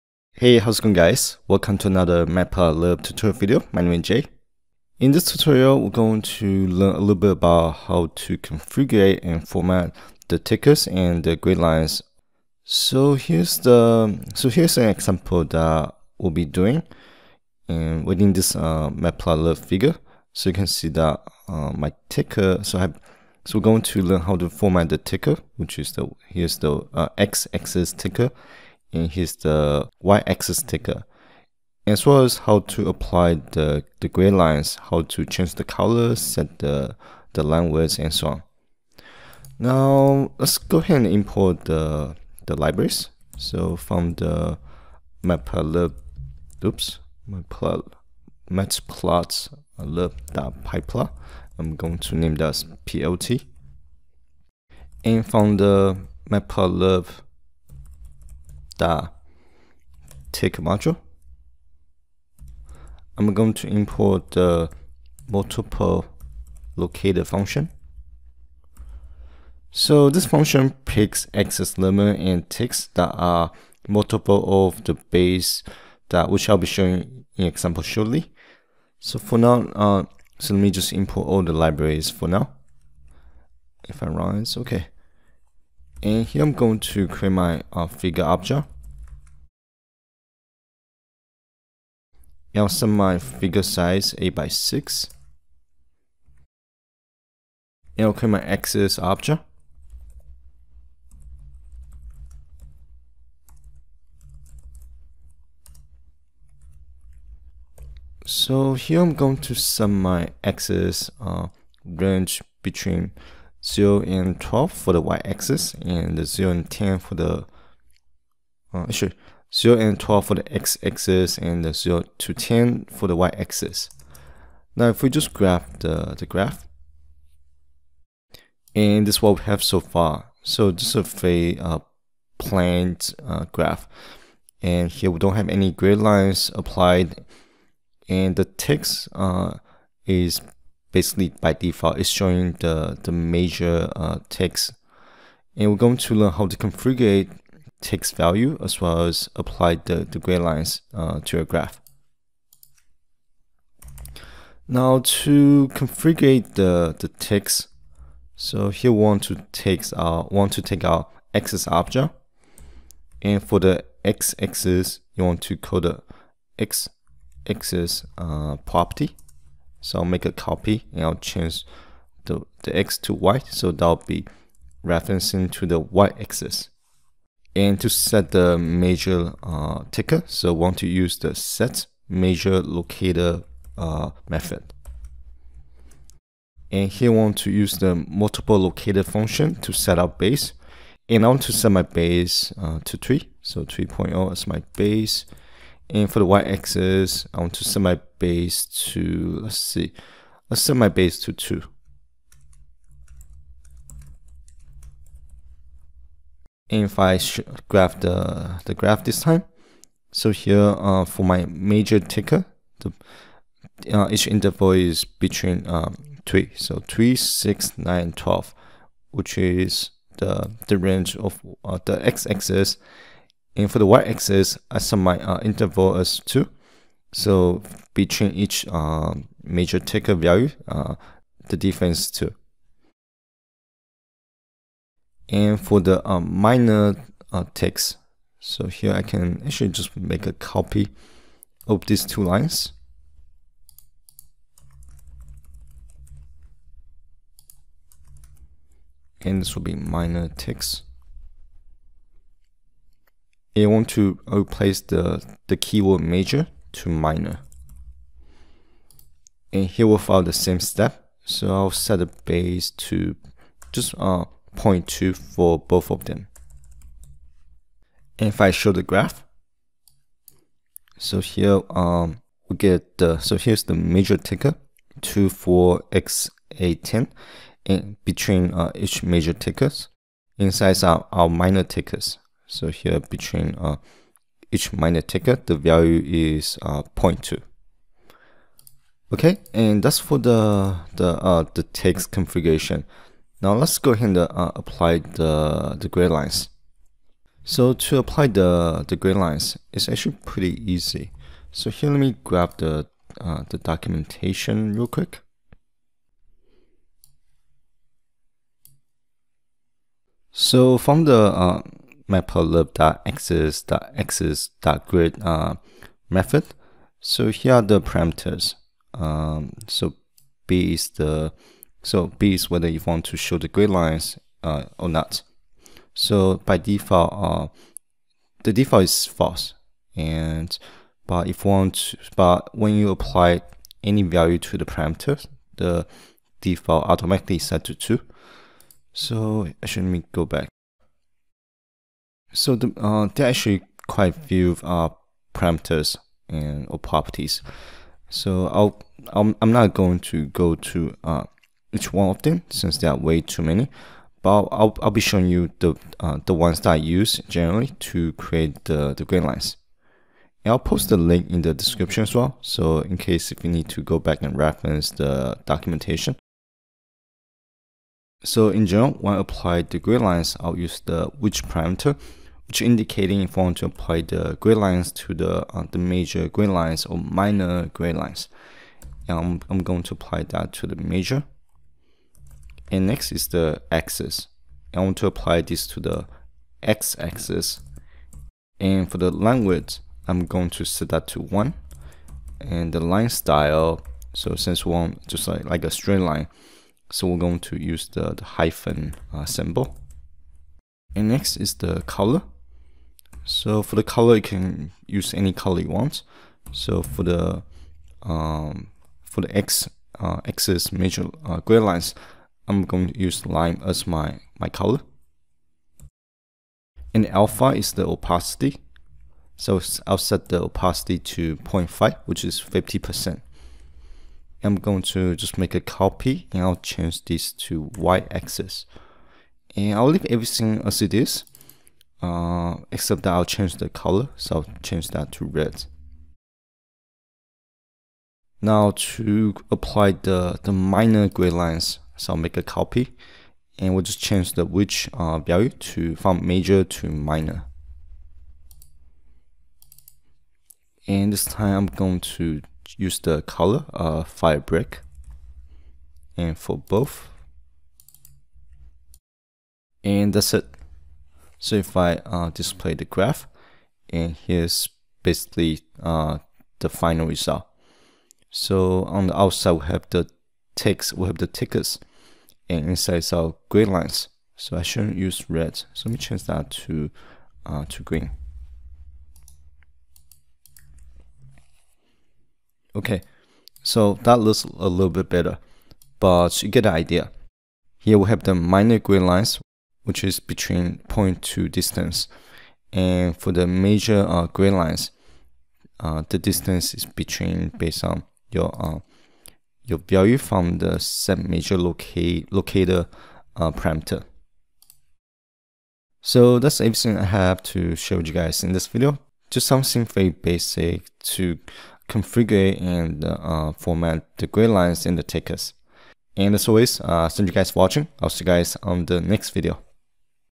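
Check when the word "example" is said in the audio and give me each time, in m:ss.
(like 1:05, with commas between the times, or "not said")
0:14, 1:17.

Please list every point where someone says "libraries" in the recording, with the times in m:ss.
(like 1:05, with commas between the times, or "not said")
0:42, 1:21.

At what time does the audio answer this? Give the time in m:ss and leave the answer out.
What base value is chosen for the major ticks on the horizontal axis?
3:13.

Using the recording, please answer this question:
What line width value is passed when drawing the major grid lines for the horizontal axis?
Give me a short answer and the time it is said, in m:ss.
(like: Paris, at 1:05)
1, at 6:31.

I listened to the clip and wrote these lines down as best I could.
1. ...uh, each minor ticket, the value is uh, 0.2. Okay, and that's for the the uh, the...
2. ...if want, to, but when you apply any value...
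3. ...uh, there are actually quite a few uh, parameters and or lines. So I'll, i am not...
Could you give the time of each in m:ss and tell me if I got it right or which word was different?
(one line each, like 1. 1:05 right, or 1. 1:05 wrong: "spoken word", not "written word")
1. 4:43 right
2. 5:31 right
3. 5:42 wrong: "properties", not "lines".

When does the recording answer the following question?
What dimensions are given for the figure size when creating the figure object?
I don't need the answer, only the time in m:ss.
1:34.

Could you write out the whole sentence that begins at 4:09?
And this will be minor ticks you want to replace the, the keyword major to minor.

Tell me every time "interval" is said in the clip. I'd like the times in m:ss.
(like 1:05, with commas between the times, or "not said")
3:34, 3:45.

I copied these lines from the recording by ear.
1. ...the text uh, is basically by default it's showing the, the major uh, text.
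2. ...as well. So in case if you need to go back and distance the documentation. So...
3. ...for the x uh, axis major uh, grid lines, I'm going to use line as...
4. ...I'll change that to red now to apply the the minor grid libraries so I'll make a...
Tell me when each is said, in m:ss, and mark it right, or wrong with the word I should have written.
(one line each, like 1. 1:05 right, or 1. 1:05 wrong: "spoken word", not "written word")
1. 2:18 right
2. 6:02 wrong: "reference", not "distance"
3. 6:49 right
4. 7:14 wrong: "lines", not "libraries".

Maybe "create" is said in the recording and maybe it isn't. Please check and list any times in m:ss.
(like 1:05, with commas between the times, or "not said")
1:27, 1:38, 5:58.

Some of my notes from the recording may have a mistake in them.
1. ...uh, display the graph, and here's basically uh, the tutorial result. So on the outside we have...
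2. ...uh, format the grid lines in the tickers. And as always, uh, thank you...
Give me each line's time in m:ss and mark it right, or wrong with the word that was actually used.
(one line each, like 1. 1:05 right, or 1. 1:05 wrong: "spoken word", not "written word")
1. 7:42 wrong: "final", not "tutorial"
2. 8:33 right.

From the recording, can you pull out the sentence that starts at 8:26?
So that's everything I have to show you guys in this video.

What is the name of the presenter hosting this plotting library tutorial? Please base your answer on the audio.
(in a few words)
Jie.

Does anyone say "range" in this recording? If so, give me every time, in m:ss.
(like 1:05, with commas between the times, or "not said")
1:51, 3:40.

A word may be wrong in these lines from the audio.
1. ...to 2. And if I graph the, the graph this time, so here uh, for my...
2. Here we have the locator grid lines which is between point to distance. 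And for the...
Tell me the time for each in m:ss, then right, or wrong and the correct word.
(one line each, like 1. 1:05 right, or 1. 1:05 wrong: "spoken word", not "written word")
1. 3:21 right
2. 8:07 wrong: "minor", not "locator".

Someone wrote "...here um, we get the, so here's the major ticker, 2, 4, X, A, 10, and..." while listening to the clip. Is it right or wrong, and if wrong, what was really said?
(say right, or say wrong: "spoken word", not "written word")
right.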